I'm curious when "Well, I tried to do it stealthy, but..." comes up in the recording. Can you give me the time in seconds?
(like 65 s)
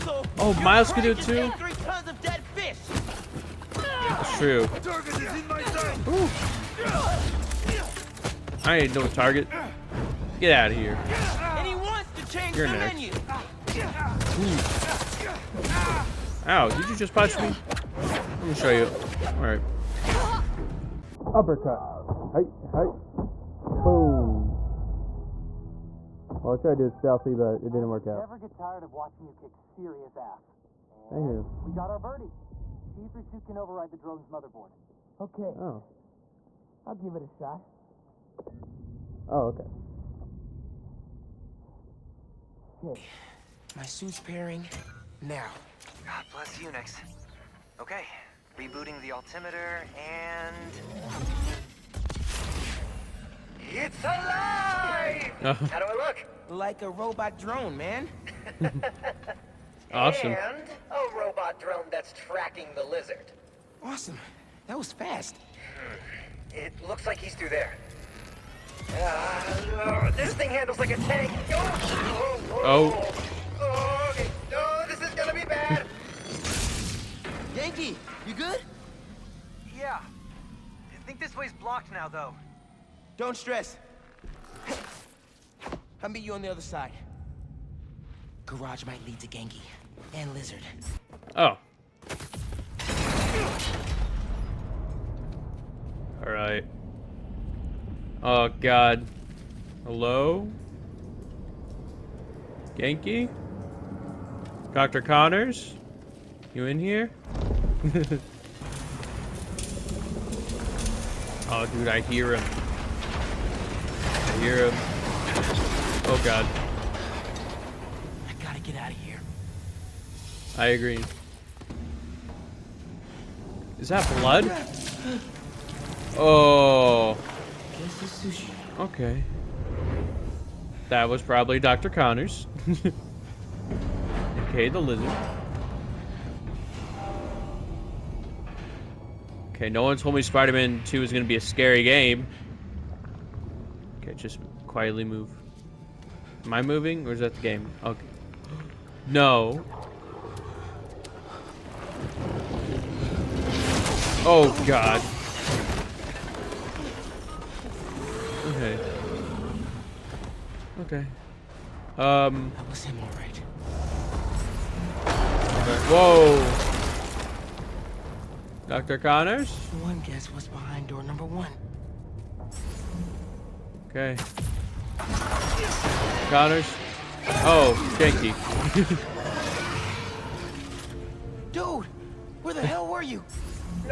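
26 s.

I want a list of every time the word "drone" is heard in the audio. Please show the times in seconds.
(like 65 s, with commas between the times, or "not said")
33 s, 57 s, 61 s.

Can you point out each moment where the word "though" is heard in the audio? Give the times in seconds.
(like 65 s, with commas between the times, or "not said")
82 s.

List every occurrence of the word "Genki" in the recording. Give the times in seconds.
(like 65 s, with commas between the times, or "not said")
89 s, 102 s.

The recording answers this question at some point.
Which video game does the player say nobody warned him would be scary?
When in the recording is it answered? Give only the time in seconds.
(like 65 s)
140 s.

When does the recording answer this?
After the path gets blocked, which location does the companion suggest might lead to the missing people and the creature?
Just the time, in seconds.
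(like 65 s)
88 s.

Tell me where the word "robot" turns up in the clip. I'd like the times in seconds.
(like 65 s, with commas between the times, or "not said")
56 s, 61 s.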